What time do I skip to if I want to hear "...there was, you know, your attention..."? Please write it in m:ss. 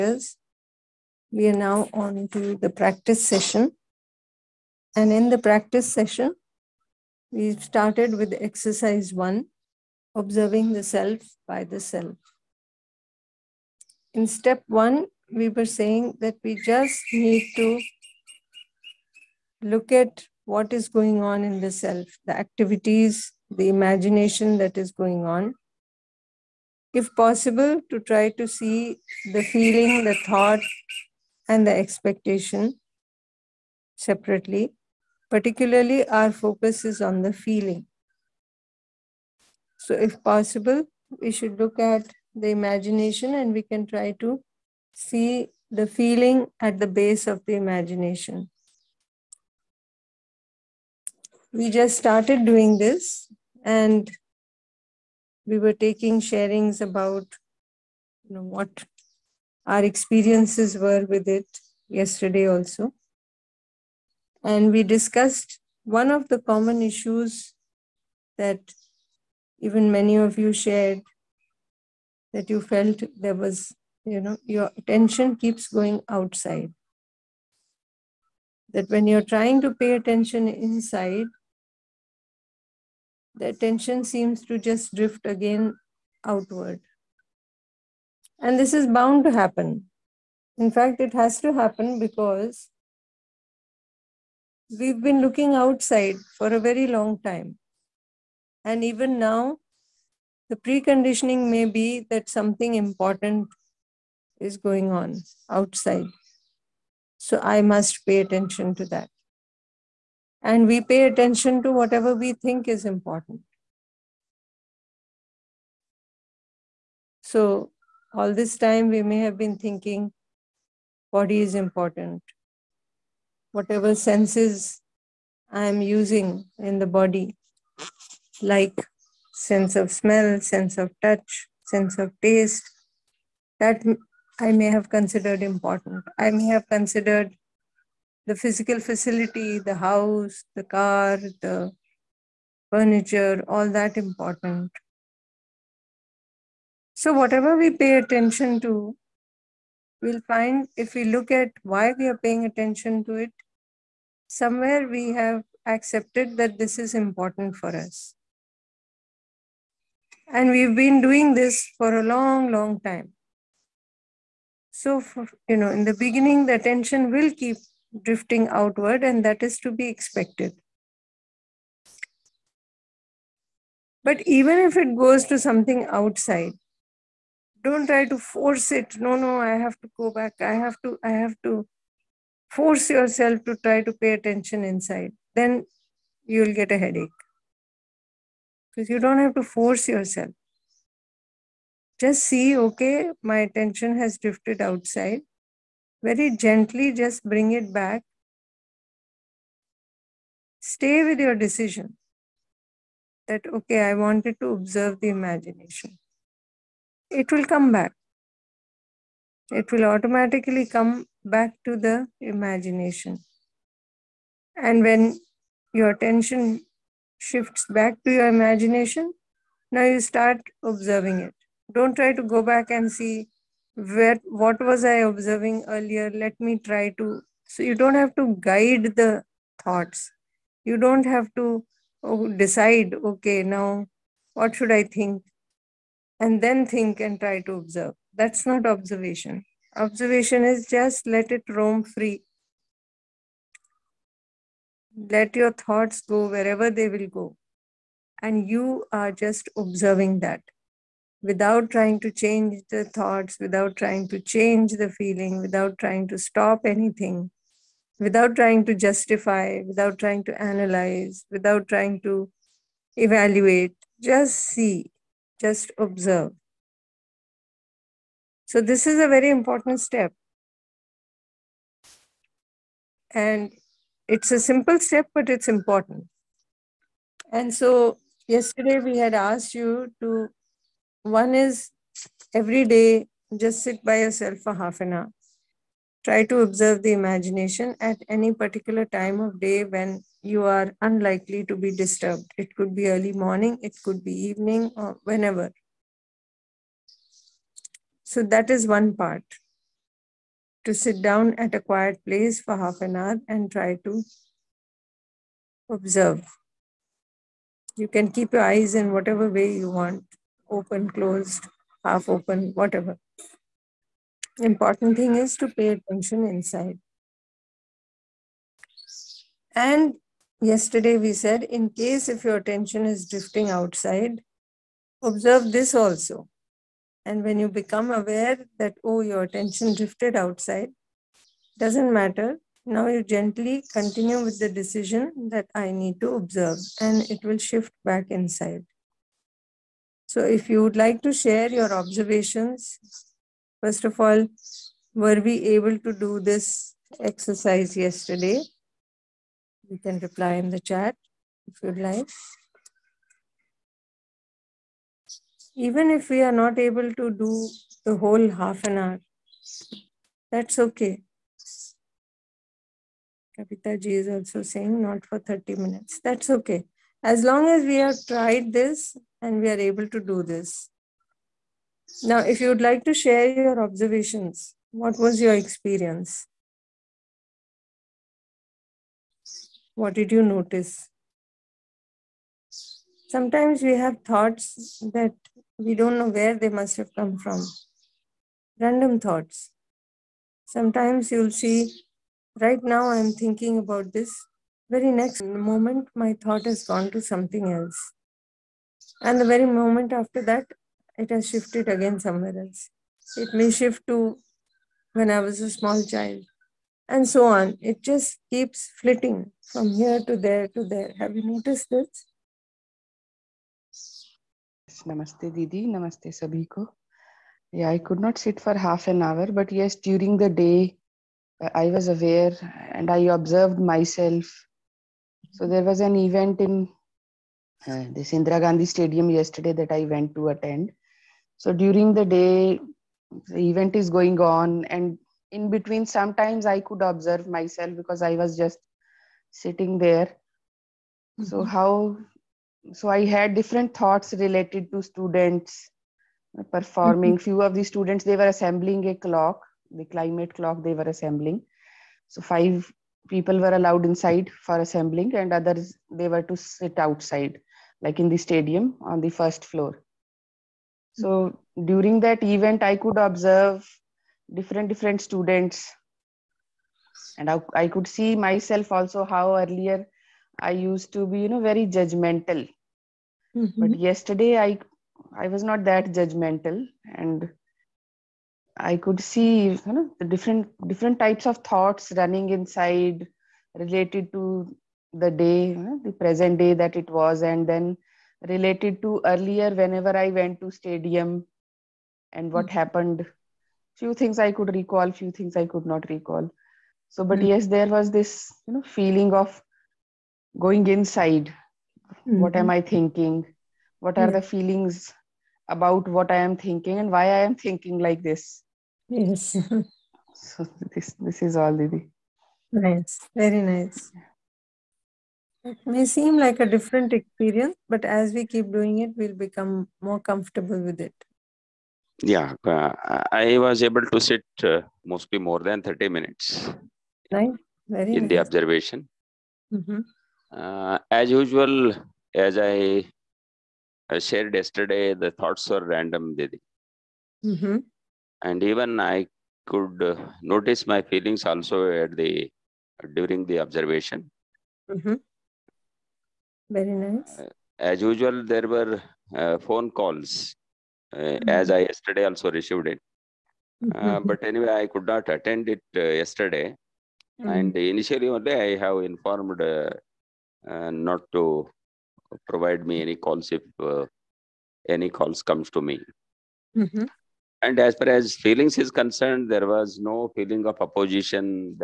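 1:13.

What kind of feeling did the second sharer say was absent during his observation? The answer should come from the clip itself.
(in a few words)
Opposition.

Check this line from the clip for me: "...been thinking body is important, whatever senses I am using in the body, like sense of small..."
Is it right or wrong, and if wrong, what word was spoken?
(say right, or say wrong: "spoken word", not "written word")
wrong: "smell", not "small".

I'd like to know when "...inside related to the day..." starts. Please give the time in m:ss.
8:02.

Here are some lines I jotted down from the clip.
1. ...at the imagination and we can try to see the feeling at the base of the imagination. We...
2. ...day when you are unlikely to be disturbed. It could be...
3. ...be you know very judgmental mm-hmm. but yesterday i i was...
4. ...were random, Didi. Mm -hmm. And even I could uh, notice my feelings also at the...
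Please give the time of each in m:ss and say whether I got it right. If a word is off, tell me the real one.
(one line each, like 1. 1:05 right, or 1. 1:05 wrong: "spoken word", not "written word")
1. 0:41 right
2. 4:49 right
3. 7:51 right
4. 8:55 right.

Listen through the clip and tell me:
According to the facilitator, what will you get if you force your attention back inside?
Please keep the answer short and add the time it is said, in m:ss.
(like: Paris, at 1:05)
A headache, at 3:06.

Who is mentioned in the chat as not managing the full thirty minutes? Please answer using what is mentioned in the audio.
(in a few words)
Kapita ji.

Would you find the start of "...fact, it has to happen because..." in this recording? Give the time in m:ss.
1:30.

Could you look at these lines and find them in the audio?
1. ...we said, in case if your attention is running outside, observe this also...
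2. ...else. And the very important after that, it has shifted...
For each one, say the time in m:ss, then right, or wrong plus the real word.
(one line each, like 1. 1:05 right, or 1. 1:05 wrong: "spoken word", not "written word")
1. 5:20 wrong: "drifting", not "running"
2. 6:37 wrong: "moment", not "important".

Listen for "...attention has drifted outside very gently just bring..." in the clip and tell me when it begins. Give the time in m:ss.
3:13.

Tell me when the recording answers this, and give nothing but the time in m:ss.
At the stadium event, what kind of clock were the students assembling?
7:29.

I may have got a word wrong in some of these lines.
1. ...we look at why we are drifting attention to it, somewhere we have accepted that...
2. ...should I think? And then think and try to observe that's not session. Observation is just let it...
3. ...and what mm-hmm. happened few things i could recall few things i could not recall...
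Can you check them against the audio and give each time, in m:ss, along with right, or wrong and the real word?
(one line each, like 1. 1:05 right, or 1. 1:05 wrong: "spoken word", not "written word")
1. 2:30 wrong: "paying", not "drifting"
2. 3:54 wrong: "observation", not "session"
3. 8:12 right.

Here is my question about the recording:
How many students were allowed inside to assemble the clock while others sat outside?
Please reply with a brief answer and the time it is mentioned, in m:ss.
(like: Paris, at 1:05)
5, at 7:32.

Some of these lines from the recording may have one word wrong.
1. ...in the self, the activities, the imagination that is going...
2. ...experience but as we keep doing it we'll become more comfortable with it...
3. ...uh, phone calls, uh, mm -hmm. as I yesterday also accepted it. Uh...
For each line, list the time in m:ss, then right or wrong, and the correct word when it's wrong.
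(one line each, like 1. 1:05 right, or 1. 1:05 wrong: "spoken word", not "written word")
1. 0:21 right
2. 8:36 right
3. 9:09 wrong: "received", not "accepted".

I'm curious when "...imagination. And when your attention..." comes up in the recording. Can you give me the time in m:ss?
3:32.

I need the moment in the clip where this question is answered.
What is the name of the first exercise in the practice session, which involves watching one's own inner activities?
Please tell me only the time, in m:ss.
0:10.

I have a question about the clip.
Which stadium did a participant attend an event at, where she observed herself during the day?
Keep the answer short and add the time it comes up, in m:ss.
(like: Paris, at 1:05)
Indira Gandhi Stadium, at 7:08.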